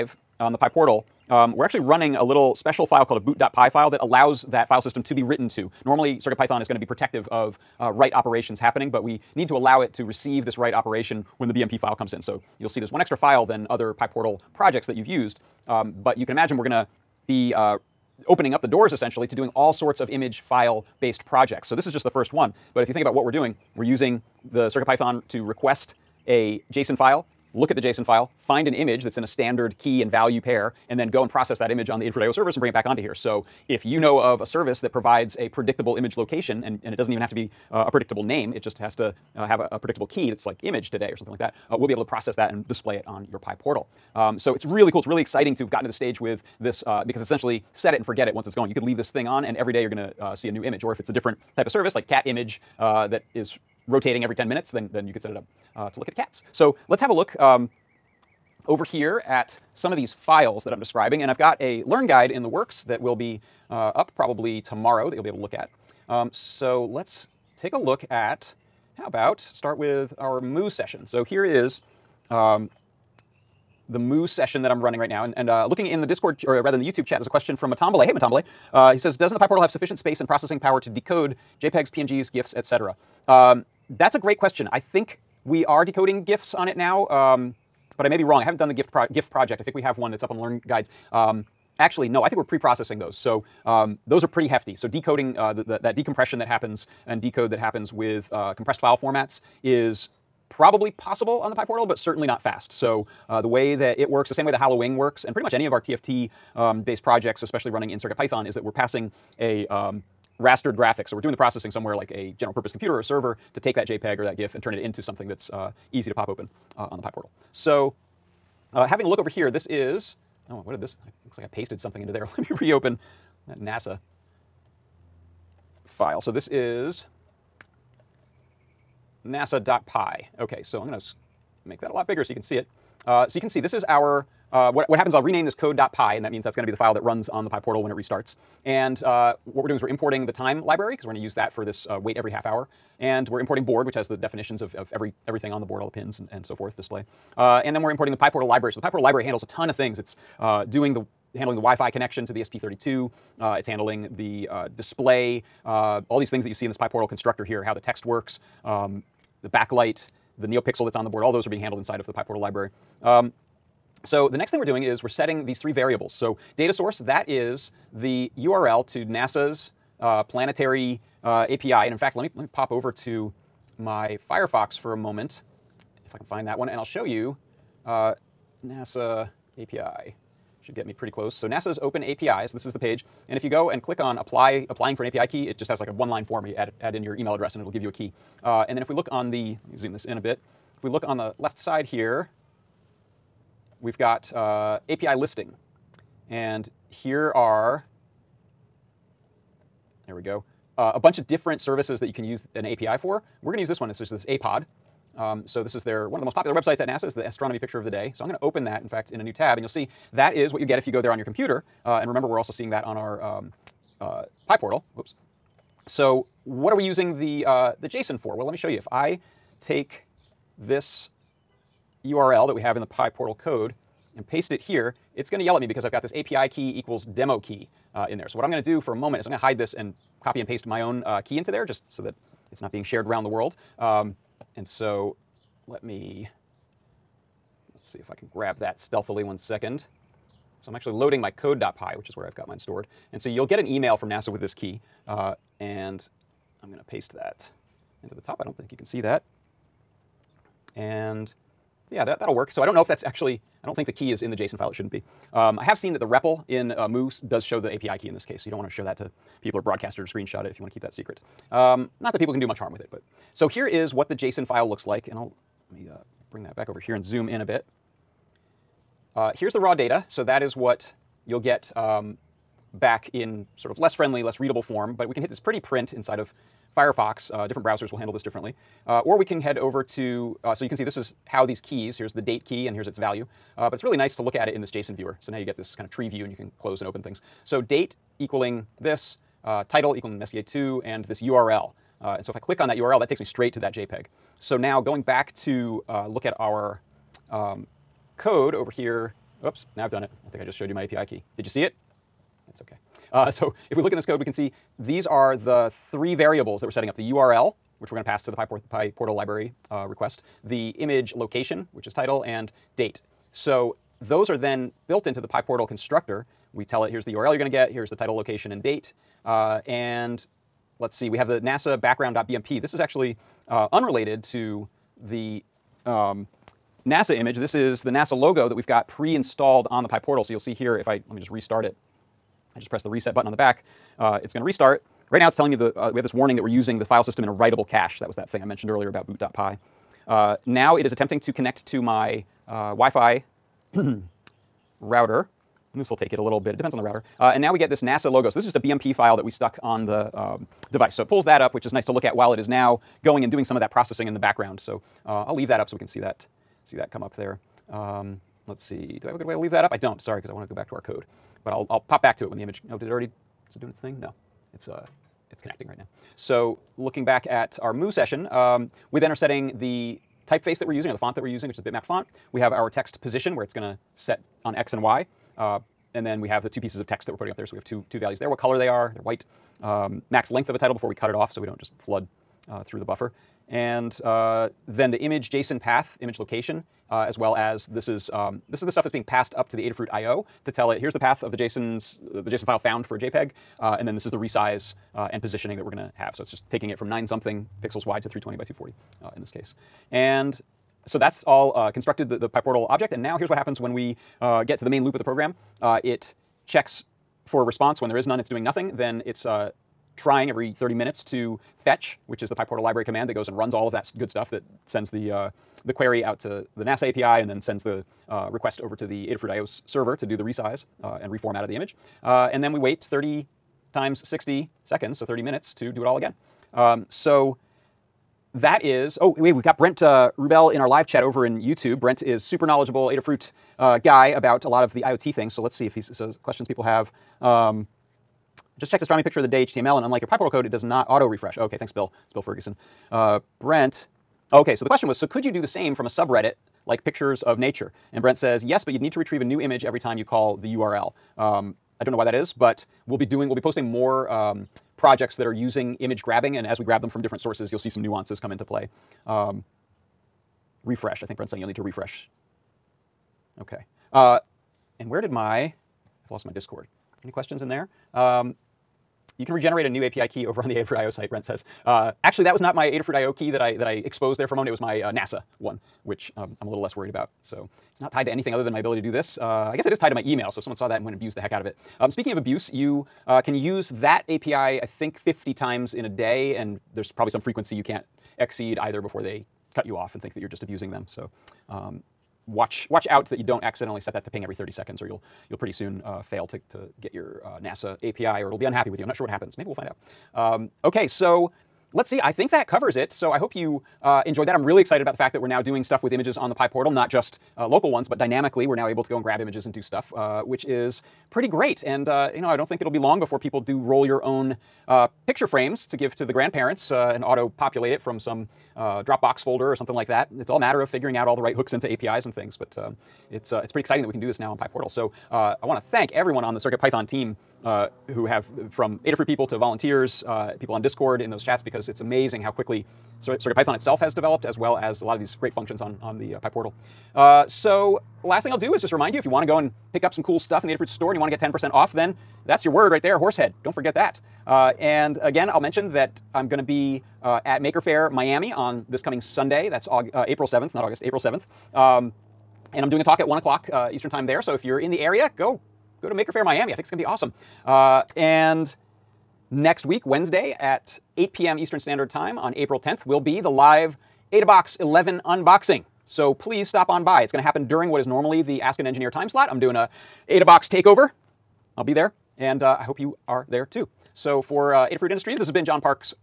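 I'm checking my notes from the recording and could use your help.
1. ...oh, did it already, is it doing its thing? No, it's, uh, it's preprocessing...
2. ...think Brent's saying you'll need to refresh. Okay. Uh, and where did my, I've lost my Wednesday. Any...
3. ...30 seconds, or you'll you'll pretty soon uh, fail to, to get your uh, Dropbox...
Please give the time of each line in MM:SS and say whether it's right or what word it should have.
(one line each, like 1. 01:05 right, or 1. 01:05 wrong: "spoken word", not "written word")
1. 06:02 wrong: "connecting", not "preprocessing"
2. 07:41 wrong: "Discord", not "Wednesday"
3. 08:14 wrong: "NASA", not "Dropbox".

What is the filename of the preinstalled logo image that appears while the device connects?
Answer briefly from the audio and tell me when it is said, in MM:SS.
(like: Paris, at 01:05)
NASA background.bmp, at 05:21.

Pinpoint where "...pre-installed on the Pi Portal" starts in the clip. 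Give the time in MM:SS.
05:28.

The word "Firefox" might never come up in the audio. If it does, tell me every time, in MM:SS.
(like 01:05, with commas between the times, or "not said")
02:54, 04:36.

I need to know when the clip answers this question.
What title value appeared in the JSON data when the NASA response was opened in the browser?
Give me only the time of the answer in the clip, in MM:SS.
04:50.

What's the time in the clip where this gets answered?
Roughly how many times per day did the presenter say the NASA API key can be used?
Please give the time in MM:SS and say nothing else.
08:04.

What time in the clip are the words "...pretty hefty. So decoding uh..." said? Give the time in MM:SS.
01:34.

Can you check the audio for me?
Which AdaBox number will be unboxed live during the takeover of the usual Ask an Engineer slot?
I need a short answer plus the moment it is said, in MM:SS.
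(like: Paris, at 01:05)
AdaBox 11, at 09:24.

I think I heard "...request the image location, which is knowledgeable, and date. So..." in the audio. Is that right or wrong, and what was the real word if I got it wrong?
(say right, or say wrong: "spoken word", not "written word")
wrong: "title", not "knowledgeable".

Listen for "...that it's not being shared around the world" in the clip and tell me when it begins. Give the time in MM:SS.
03:52.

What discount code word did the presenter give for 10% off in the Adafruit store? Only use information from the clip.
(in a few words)
horsehead.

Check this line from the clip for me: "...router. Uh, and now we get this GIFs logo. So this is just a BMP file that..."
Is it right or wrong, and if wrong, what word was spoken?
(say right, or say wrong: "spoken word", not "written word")
wrong: "NASA", not "GIFs".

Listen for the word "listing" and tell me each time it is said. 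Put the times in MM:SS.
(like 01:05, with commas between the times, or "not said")
03:15.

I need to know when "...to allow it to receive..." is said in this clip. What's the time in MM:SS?
00:09.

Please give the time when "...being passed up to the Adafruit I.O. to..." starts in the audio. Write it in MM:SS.
06:28.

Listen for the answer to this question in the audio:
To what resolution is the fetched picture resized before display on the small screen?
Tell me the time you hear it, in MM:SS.
06:38.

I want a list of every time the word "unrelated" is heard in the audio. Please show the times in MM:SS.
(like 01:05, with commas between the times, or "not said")
05:23.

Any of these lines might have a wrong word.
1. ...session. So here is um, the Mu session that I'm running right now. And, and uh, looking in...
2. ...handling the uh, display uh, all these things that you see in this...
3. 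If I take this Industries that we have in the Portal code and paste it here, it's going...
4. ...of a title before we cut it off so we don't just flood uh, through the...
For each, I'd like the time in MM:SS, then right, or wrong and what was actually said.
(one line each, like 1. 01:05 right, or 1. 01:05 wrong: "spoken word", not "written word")
1. 01:10 right
2. 02:33 right
3. 03:38 wrong: "URL", not "Industries"
4. 06:20 right.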